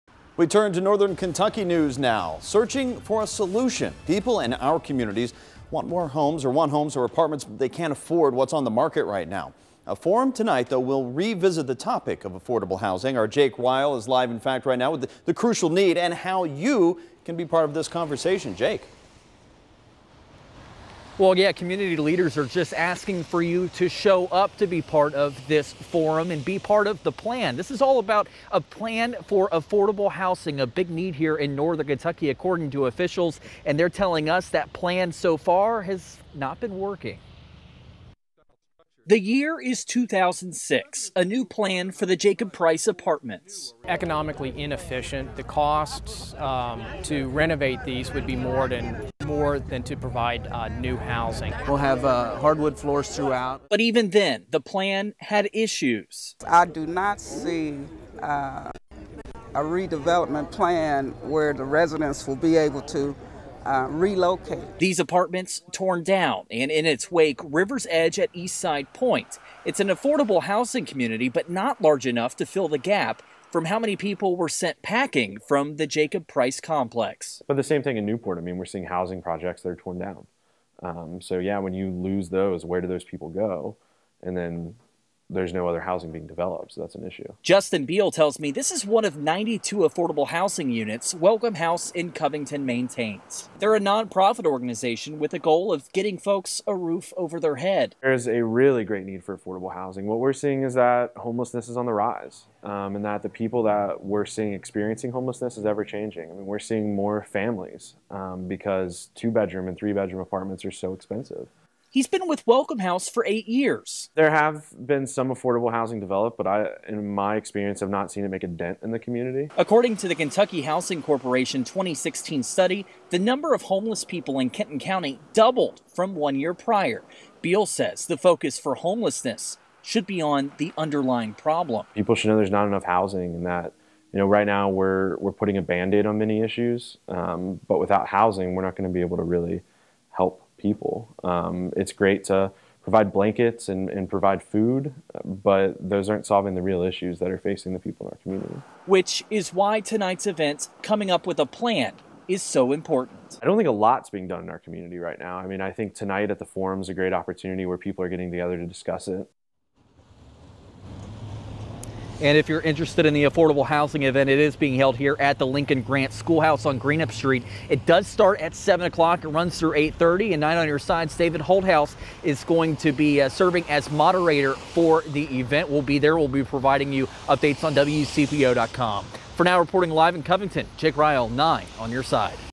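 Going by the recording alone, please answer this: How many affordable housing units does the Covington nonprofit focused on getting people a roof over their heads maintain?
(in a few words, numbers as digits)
92.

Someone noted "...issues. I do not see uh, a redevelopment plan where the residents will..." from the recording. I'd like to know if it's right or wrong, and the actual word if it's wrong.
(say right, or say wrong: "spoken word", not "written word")
right.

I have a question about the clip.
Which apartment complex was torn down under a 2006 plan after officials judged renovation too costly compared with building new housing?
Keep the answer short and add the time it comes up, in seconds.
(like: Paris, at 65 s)
Jacob Price apartments, at 42 s.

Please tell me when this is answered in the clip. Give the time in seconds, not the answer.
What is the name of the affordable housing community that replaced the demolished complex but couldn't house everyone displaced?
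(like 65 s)
67 s.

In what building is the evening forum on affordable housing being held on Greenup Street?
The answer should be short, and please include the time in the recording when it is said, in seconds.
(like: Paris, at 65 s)
Lincoln Grant Schoolhouse, at 165 s.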